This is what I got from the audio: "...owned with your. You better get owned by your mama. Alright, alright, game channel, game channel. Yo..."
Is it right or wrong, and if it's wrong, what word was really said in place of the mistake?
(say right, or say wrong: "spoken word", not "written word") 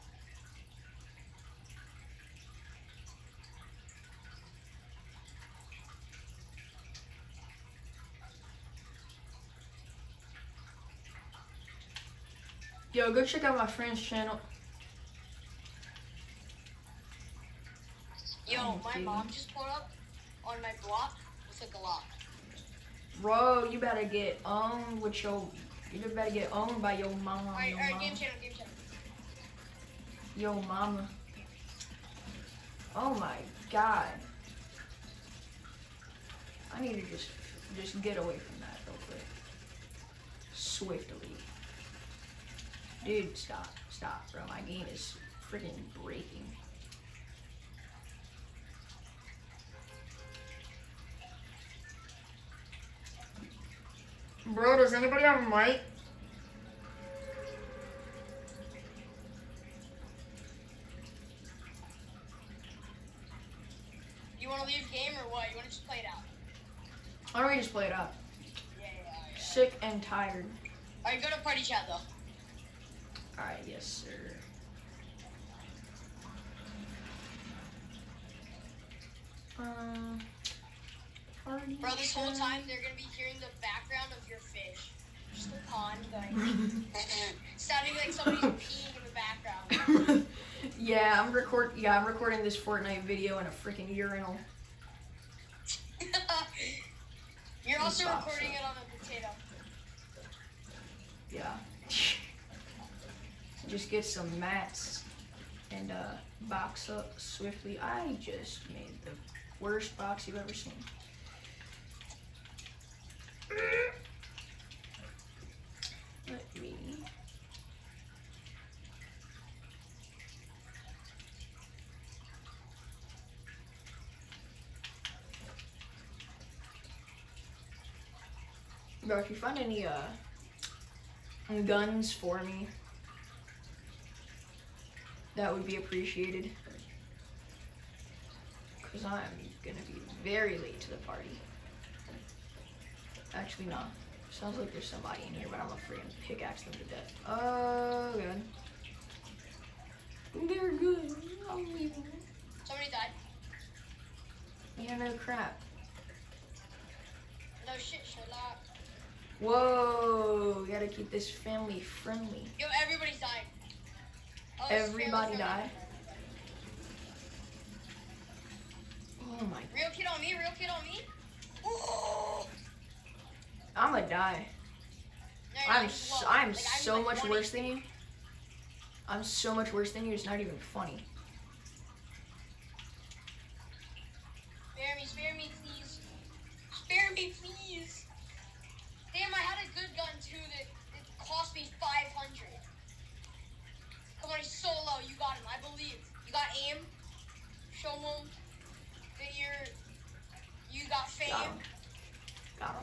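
right.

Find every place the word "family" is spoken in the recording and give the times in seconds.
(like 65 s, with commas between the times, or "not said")
161 s.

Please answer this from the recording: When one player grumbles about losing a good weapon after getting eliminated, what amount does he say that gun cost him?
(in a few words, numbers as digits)
500.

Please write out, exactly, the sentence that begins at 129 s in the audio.
Bro, if you find any uh, guns for me, that would be appreciated.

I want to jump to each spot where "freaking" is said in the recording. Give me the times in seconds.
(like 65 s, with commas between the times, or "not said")
45 s, 93 s.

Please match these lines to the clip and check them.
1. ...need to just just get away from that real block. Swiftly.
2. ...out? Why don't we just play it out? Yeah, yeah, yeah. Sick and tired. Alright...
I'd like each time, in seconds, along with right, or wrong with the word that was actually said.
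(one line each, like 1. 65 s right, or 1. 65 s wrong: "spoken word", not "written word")
1. 36 s wrong: "quick", not "block"
2. 66 s right.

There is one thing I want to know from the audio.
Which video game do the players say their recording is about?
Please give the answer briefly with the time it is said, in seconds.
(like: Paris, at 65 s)
Fortnite, at 92 s.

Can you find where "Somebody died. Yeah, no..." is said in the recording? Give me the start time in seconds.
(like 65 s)
152 s.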